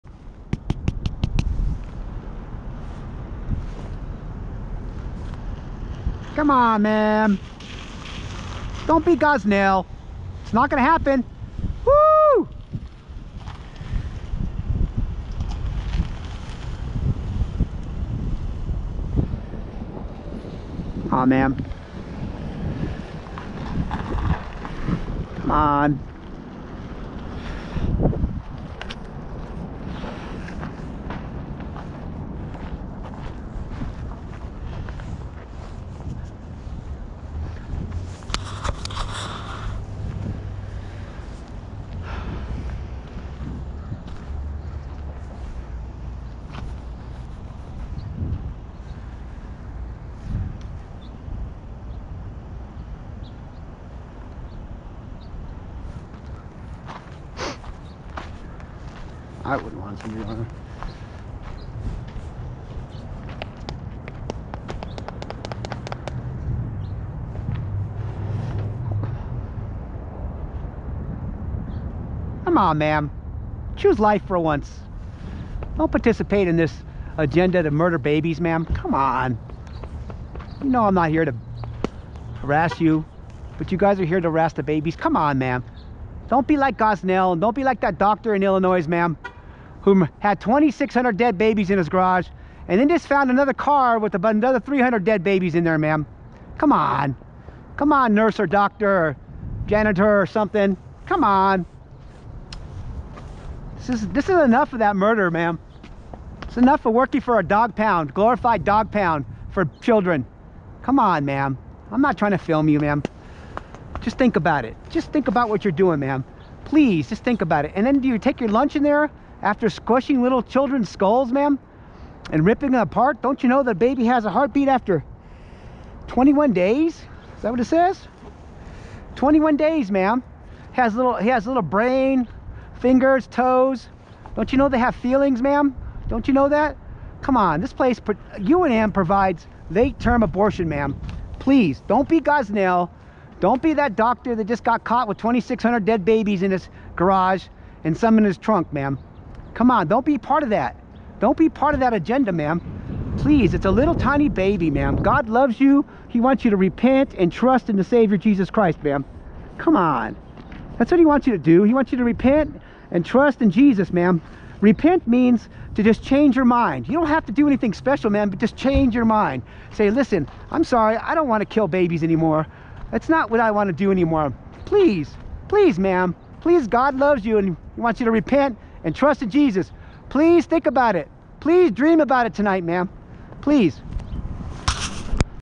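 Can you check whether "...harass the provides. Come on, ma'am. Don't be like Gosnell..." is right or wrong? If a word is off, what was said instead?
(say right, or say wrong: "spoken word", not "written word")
wrong: "babies", not "provides".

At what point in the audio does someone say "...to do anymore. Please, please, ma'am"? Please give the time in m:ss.
2:53.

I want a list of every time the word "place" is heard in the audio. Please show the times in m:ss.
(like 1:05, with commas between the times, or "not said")
2:17.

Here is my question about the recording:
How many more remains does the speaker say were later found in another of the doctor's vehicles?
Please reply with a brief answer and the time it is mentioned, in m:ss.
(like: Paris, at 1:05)
300, at 1:34.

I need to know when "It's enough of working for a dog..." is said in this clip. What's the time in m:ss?
1:46.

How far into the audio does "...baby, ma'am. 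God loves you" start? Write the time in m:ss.
2:34.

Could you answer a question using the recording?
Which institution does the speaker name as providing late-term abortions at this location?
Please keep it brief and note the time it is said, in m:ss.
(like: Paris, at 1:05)
UNM, at 2:17.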